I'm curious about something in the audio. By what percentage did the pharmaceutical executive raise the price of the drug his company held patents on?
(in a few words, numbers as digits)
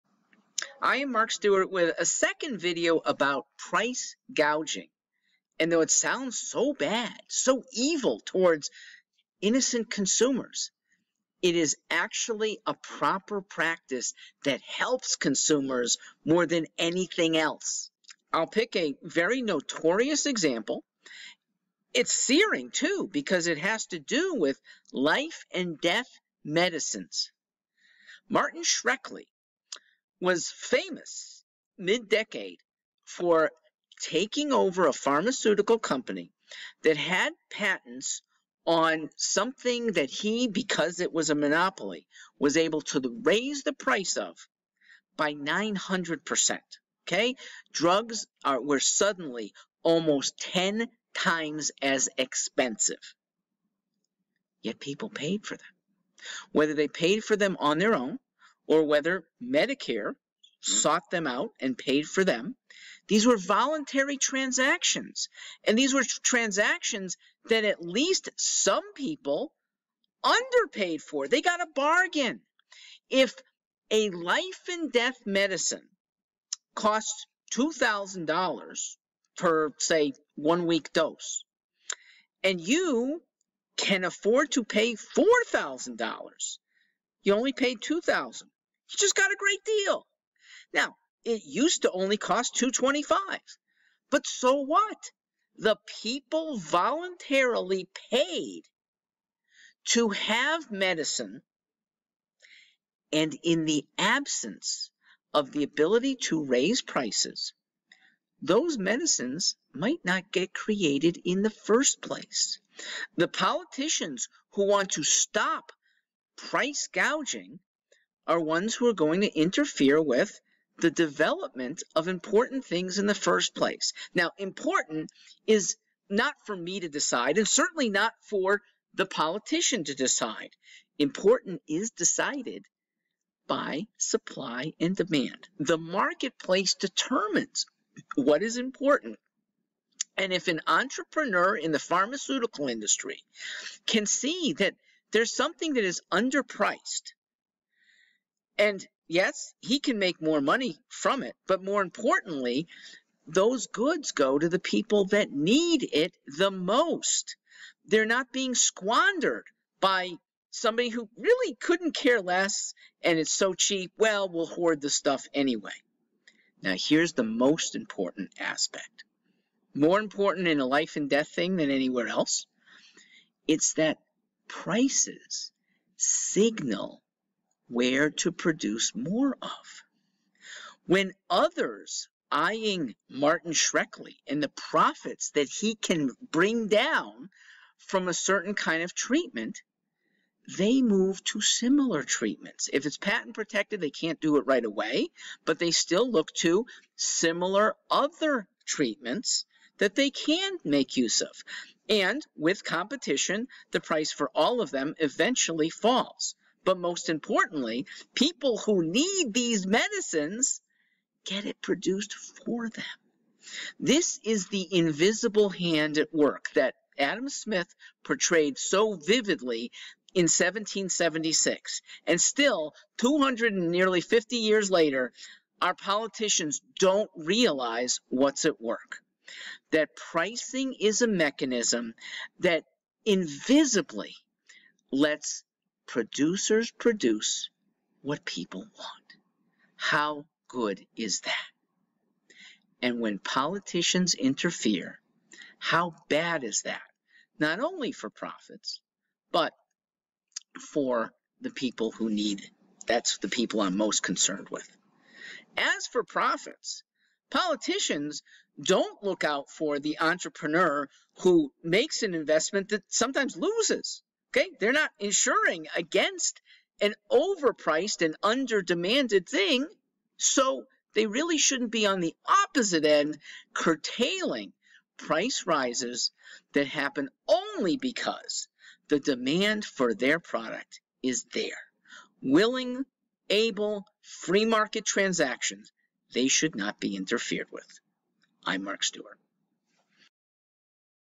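900%.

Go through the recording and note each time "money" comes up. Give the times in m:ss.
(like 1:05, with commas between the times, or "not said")
2:30.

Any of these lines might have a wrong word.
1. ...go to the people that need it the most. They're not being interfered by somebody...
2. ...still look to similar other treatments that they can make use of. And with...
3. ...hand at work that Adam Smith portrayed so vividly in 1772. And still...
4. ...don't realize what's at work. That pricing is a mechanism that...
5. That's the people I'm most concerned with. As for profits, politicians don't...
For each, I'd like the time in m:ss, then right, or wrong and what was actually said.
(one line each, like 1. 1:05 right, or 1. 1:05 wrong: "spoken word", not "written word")
1. 2:34 wrong: "squandered", not "interfered"
2. 3:15 right
3. 3:35 wrong: "1776", not "1772"
4. 3:46 right
5. 4:12 right.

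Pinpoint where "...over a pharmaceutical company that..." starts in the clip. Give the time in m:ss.
0:34.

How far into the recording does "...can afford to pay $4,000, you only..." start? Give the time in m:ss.
1:23.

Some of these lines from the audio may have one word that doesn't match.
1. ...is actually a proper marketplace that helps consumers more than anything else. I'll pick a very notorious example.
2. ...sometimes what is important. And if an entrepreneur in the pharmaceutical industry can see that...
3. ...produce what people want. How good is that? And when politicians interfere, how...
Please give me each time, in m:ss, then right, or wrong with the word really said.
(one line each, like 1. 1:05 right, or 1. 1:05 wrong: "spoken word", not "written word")
1. 0:11 wrong: "practice", not "marketplace"
2. 2:16 wrong: "determines", not "sometimes"
3. 3:56 right.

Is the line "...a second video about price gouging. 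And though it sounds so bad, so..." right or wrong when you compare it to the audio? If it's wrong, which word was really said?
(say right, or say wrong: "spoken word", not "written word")
right.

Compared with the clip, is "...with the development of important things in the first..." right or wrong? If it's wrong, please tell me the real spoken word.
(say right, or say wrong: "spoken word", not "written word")
right.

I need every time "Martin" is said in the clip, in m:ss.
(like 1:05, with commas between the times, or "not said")
0:28, 3:03.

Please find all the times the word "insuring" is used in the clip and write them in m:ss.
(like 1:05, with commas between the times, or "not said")
4:24.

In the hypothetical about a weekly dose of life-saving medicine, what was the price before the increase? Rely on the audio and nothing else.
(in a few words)
225.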